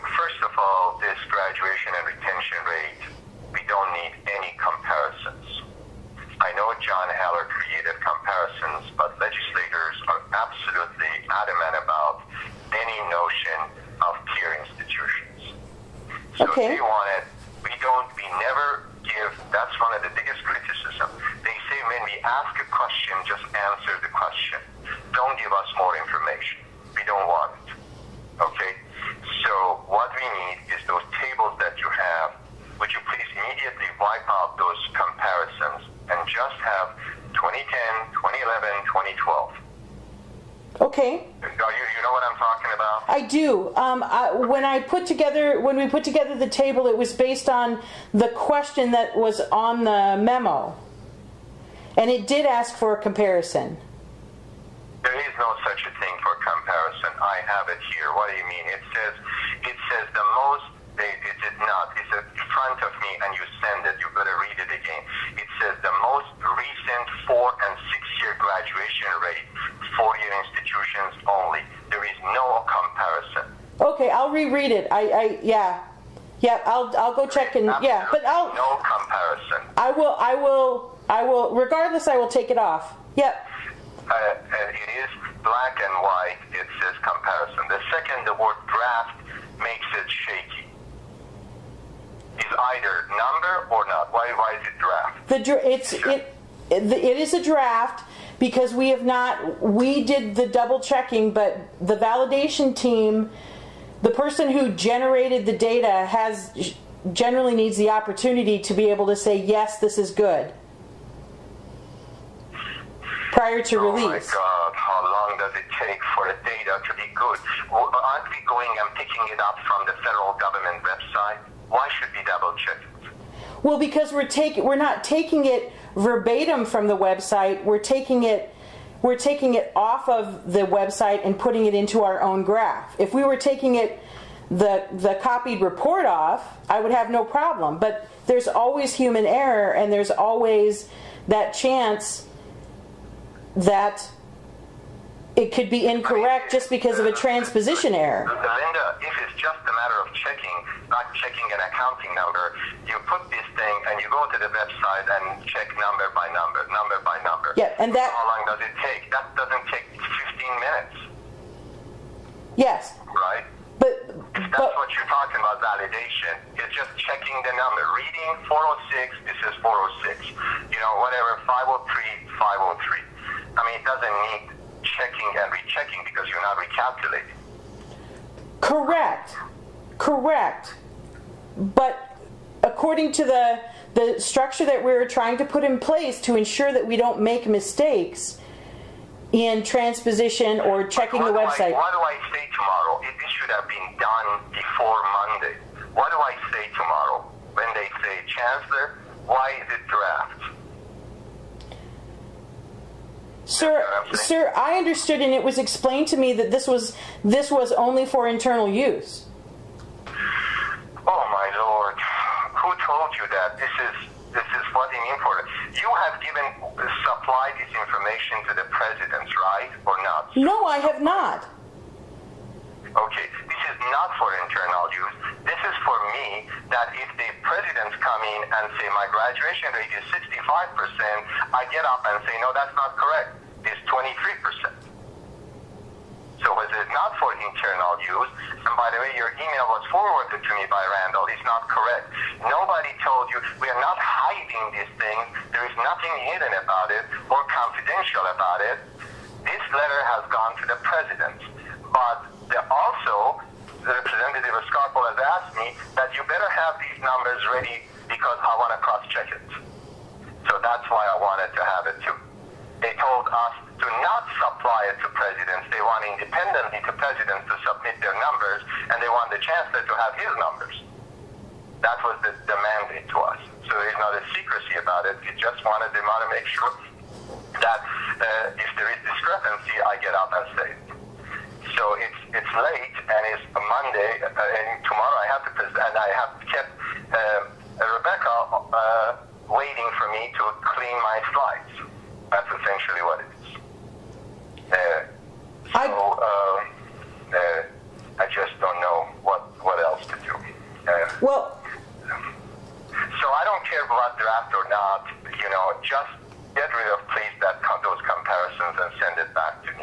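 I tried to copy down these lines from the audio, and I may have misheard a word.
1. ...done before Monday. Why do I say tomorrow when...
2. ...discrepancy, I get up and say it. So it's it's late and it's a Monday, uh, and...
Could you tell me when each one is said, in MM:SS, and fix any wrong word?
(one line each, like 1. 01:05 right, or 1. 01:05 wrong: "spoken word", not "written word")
1. 03:13 right
2. 04:39 right.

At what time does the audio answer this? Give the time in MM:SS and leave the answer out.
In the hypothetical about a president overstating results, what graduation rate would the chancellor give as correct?
03:53.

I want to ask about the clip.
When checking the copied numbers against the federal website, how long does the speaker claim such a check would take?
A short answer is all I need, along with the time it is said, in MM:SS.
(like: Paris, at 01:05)
15 minutes, at 02:39.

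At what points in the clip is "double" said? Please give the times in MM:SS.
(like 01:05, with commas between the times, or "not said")
01:40, 02:02.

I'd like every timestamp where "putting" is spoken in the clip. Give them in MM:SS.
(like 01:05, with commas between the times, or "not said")
02:11.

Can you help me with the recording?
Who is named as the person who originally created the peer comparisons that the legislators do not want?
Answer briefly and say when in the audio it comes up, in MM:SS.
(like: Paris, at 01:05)
John Heller, at 00:06.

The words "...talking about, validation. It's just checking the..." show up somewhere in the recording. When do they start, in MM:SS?
02:45.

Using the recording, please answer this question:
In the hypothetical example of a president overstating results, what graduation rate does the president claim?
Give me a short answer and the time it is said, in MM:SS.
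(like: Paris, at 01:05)
65%, at 03:50.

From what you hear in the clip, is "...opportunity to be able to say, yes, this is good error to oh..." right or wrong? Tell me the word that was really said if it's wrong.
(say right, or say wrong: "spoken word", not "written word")
wrong: "prior", not "error".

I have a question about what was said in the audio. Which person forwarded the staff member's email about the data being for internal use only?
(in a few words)
Randall.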